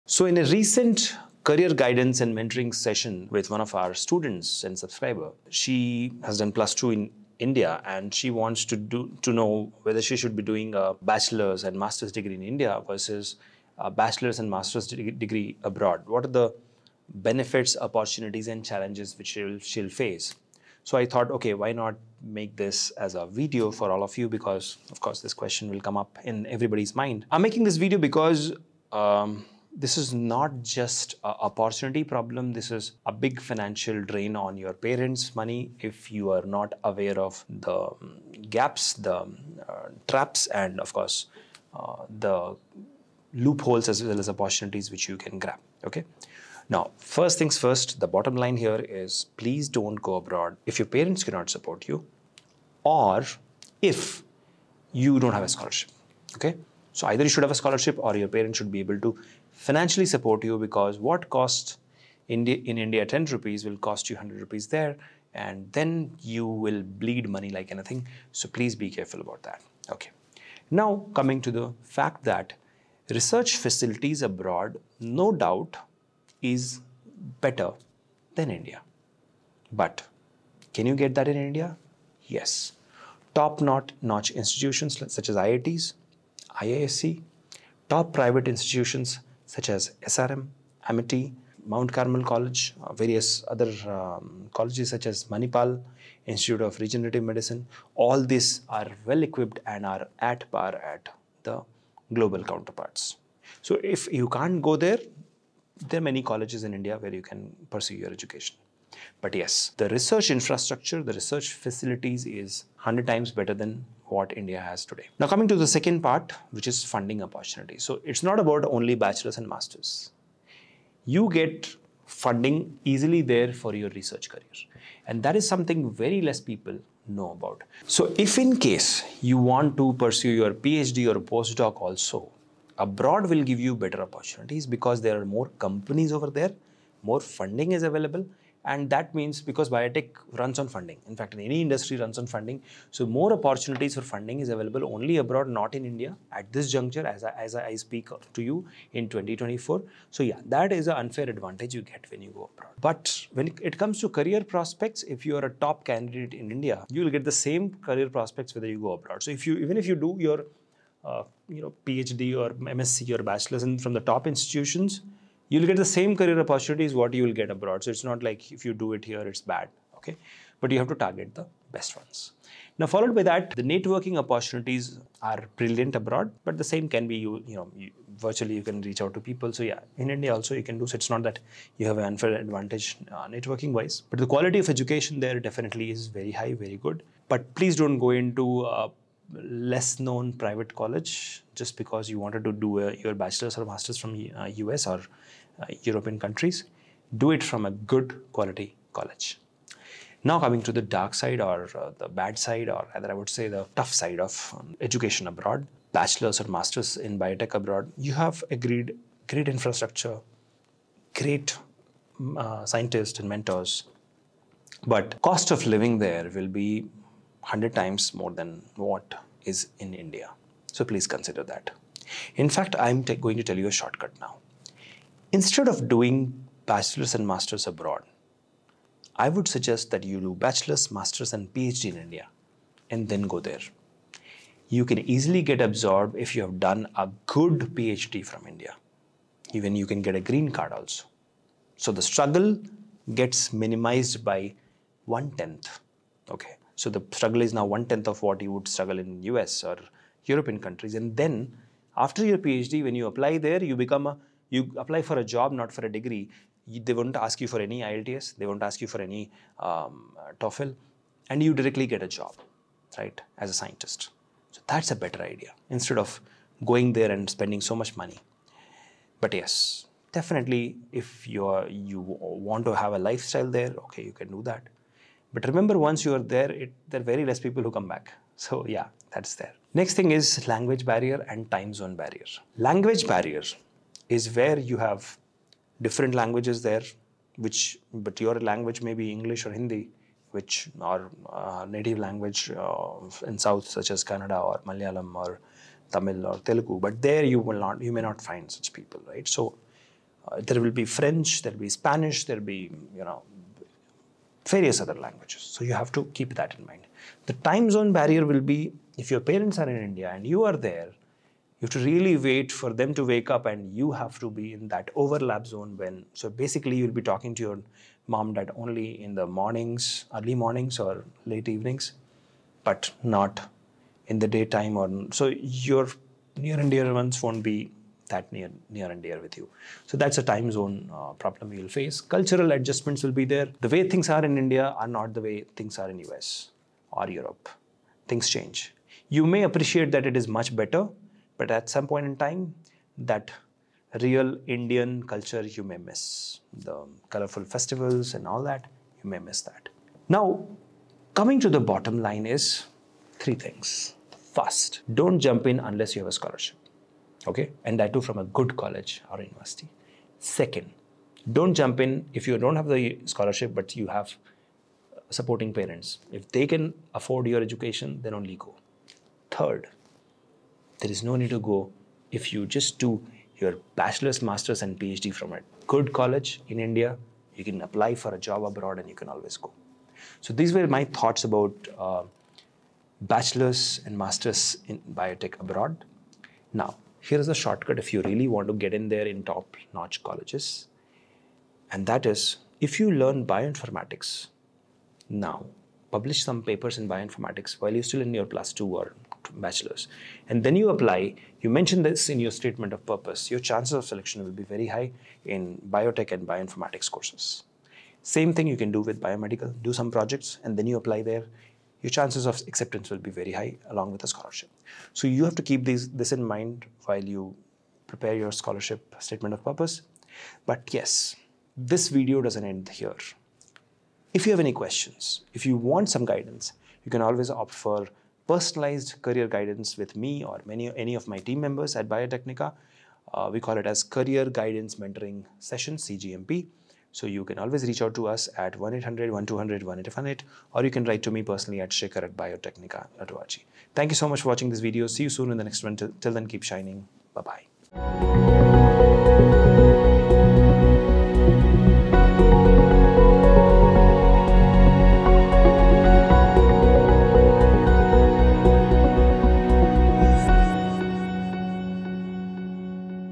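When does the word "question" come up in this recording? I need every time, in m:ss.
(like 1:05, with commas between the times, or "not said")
0:25, 7:04.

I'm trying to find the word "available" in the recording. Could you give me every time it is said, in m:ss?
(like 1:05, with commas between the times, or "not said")
2:17, 2:24.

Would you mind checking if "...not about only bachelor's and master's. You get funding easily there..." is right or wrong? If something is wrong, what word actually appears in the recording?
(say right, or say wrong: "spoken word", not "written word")
right.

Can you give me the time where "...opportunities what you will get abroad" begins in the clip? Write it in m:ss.
2:46.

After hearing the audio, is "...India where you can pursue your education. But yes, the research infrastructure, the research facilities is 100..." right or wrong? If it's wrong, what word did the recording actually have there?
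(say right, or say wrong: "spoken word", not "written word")
right.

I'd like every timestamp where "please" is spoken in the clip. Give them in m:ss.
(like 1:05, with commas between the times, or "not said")
0:49, 1:08, 3:07, 3:40.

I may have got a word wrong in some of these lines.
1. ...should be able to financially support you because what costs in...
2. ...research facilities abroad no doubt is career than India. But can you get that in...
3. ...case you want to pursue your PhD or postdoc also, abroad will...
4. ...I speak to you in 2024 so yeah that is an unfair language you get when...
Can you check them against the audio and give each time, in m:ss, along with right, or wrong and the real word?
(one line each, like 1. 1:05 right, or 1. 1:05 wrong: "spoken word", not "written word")
1. 0:58 right
2. 1:13 wrong: "better", not "career"
3. 2:08 right
4. 2:27 wrong: "advantage", not "language".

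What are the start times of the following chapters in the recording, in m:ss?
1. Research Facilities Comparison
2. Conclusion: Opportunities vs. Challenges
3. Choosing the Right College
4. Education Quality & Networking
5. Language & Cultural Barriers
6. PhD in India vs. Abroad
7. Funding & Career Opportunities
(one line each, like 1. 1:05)
1. 1:10
2. 7:00
3. 5:55
4. 2:50
5. 4:39
6. 3:58
7. 1:59.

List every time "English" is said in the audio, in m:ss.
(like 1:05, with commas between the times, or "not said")
4:49.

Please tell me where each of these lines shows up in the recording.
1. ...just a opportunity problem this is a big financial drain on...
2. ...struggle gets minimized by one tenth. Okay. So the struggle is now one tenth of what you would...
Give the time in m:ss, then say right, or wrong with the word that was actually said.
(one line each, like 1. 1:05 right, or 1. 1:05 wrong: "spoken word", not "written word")
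1. 0:30 right
2. 4:02 right.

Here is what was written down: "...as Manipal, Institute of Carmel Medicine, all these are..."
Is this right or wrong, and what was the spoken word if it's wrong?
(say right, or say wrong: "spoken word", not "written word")
wrong: "Regenerative", not "Carmel".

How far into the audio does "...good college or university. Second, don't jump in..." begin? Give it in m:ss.
5:58.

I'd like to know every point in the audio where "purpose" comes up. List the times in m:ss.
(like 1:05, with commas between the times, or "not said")
6:42, 6:59.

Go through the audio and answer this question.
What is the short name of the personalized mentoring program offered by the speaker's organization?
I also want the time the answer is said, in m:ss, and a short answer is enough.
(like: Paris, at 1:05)
CGMP, at 7:15.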